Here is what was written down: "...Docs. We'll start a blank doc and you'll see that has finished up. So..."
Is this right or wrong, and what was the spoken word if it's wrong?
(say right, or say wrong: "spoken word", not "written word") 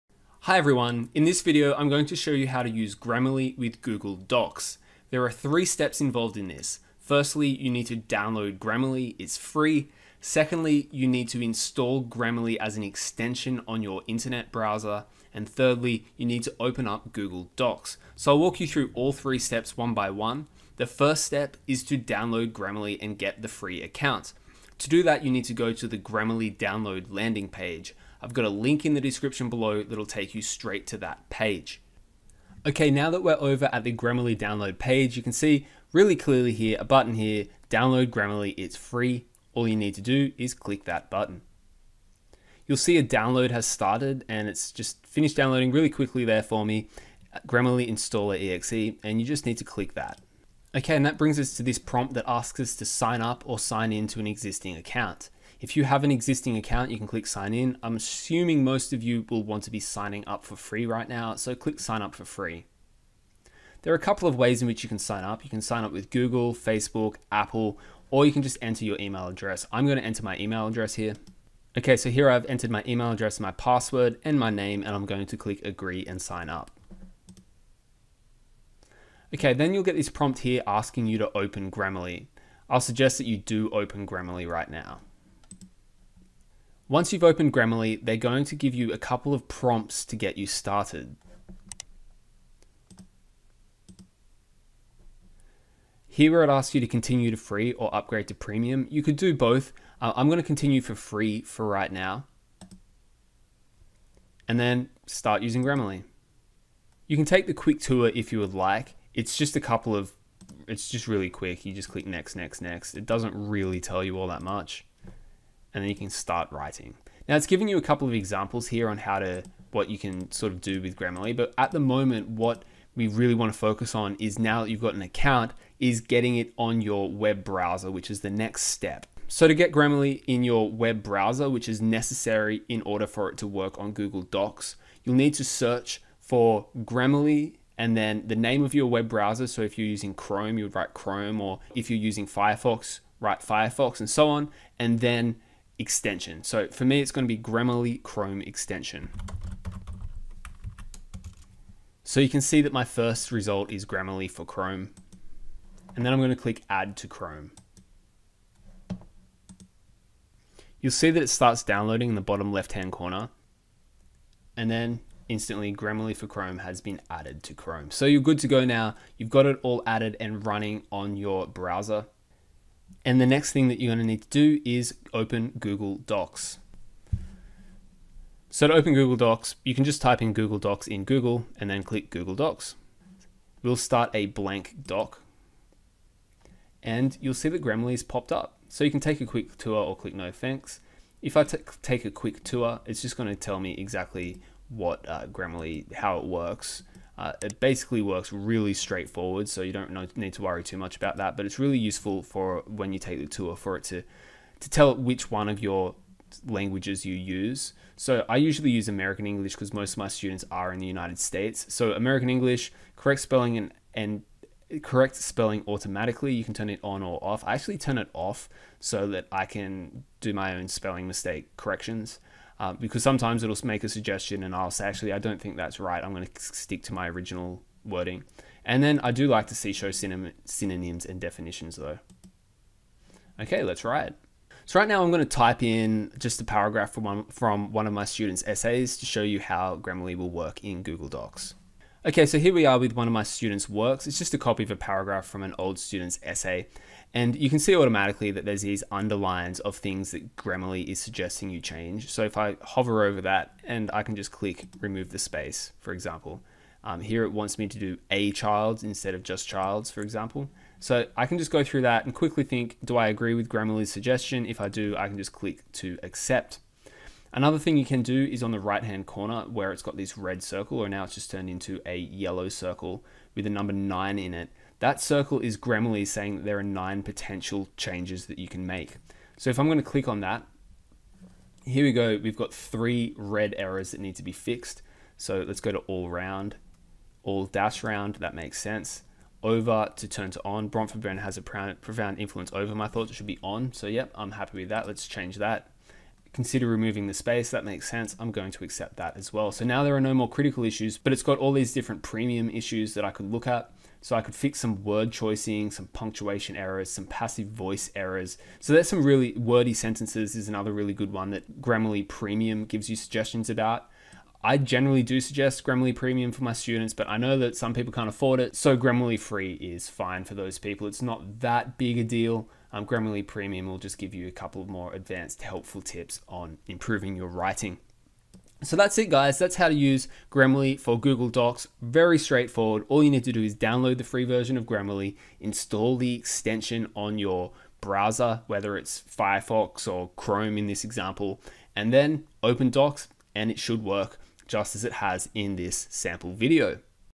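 wrong: "popped", not "finished".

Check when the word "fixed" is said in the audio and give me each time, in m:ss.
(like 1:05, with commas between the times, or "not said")
4:44.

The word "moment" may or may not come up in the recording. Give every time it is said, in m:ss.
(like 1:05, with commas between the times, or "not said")
2:01.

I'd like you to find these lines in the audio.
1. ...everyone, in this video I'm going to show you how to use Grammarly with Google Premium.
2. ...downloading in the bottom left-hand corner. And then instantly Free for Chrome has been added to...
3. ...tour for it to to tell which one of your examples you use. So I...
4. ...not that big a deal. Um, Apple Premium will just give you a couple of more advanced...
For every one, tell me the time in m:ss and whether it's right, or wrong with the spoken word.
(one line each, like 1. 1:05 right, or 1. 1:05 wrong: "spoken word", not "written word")
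1. 0:00 wrong: "Docs", not "Premium"
2. 2:41 wrong: "Grammarly", not "Free"
3. 3:23 wrong: "languages", not "examples"
4. 5:21 wrong: "Grammarly", not "Apple".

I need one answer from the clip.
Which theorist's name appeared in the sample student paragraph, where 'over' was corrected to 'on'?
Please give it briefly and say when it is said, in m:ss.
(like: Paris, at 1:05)
Bronfenbrenner, at 4:50.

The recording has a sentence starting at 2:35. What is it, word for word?
And then I'm going to click add to Chrome.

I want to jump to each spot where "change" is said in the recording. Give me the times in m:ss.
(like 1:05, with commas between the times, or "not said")
4:11, 4:37, 4:55.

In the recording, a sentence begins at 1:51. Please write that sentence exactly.
You just click next, next, next.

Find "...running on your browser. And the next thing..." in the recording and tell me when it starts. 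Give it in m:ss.
2:50.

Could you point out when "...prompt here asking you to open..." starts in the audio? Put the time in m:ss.
1:20.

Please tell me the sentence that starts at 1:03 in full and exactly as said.
There are a couple of ways in which you can sign up.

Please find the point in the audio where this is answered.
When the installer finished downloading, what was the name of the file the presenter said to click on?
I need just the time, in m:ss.
0:47.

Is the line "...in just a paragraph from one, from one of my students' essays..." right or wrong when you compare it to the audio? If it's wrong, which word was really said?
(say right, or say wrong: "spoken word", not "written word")
right.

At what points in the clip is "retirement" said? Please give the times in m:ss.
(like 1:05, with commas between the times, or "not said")
not said.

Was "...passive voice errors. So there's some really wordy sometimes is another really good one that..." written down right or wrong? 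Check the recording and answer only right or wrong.
wrong.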